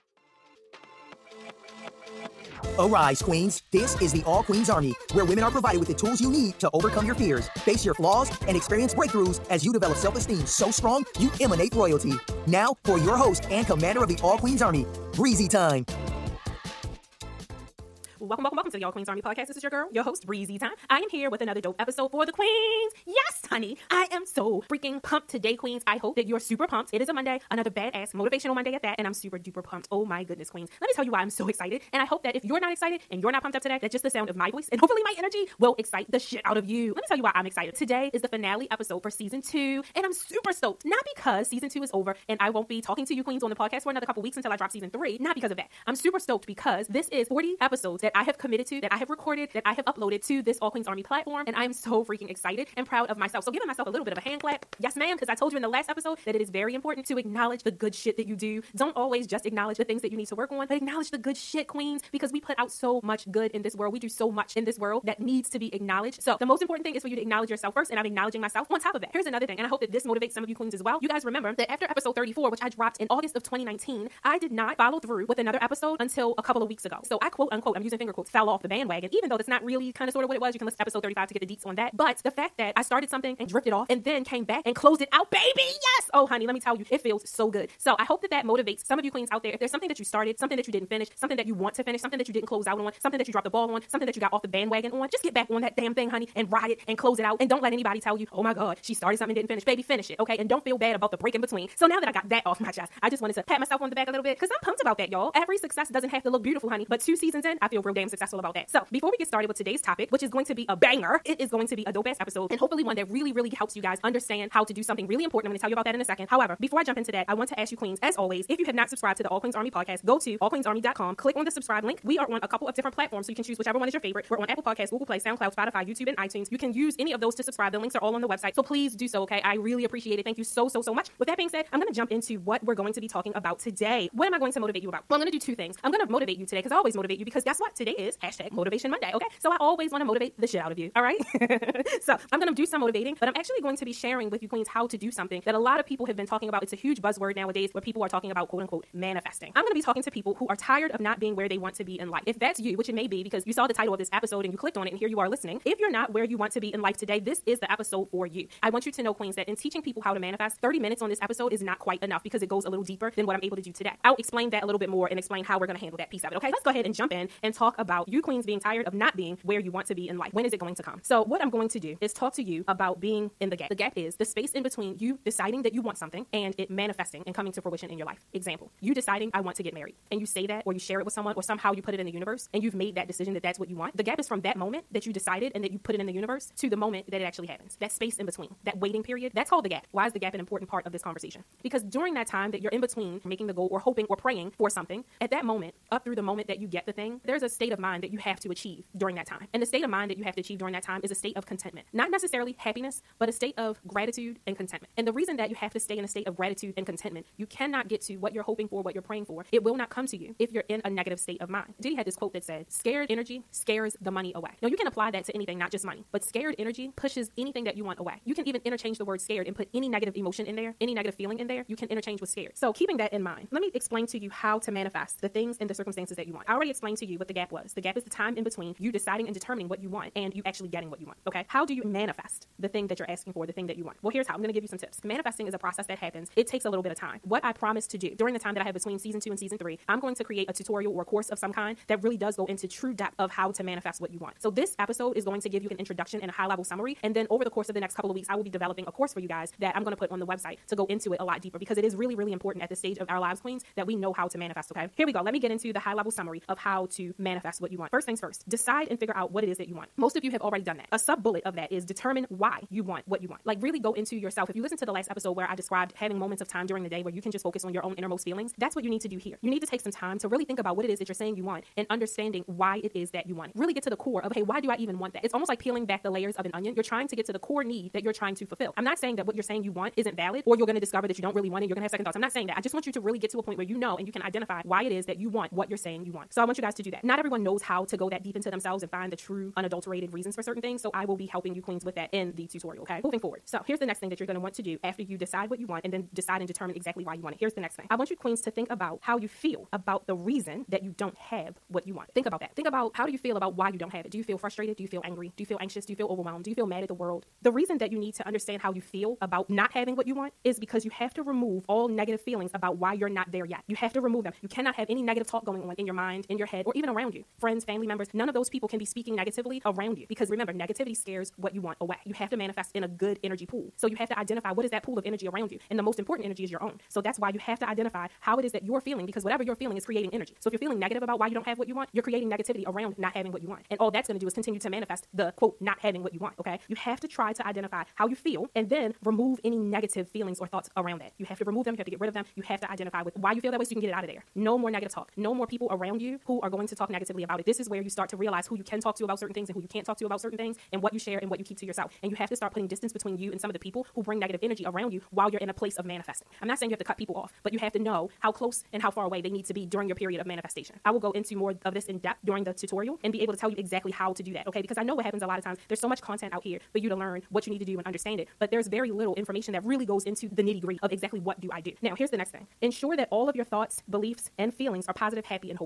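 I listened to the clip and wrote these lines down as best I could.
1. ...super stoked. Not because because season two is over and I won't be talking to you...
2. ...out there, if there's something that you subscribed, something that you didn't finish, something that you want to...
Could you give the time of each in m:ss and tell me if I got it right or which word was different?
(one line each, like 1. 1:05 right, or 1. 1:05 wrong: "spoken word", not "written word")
1. 0:40 right
2. 1:29 wrong: "started", not "subscribed".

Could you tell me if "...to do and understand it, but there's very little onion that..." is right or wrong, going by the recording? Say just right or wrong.
wrong.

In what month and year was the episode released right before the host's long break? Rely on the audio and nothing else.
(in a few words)
August 2019.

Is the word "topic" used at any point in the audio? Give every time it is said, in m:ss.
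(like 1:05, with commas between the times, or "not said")
1:49.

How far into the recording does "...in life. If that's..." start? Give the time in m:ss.
2:31.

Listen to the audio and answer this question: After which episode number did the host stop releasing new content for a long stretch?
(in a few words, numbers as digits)
34.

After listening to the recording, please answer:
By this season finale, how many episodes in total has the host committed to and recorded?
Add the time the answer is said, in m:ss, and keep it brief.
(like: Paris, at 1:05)
40, at 0:47.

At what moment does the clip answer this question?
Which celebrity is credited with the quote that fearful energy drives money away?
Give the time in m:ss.
3:31.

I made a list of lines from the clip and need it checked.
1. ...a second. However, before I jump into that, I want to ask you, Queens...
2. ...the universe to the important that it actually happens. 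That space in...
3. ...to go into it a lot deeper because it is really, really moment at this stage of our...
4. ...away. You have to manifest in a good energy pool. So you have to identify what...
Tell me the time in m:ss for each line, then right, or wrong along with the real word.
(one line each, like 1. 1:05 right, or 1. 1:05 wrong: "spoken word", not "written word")
1. 1:56 right
2. 3:06 wrong: "moment", not "important"
3. 4:10 wrong: "important", not "moment"
4. 5:21 right.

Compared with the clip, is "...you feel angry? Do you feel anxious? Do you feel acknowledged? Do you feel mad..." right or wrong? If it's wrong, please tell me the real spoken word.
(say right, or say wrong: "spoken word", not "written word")
wrong: "overwhelmed", not "acknowledged".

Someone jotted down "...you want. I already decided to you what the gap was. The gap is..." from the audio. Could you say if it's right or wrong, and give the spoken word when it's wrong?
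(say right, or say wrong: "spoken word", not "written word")
wrong: "explained", not "decided".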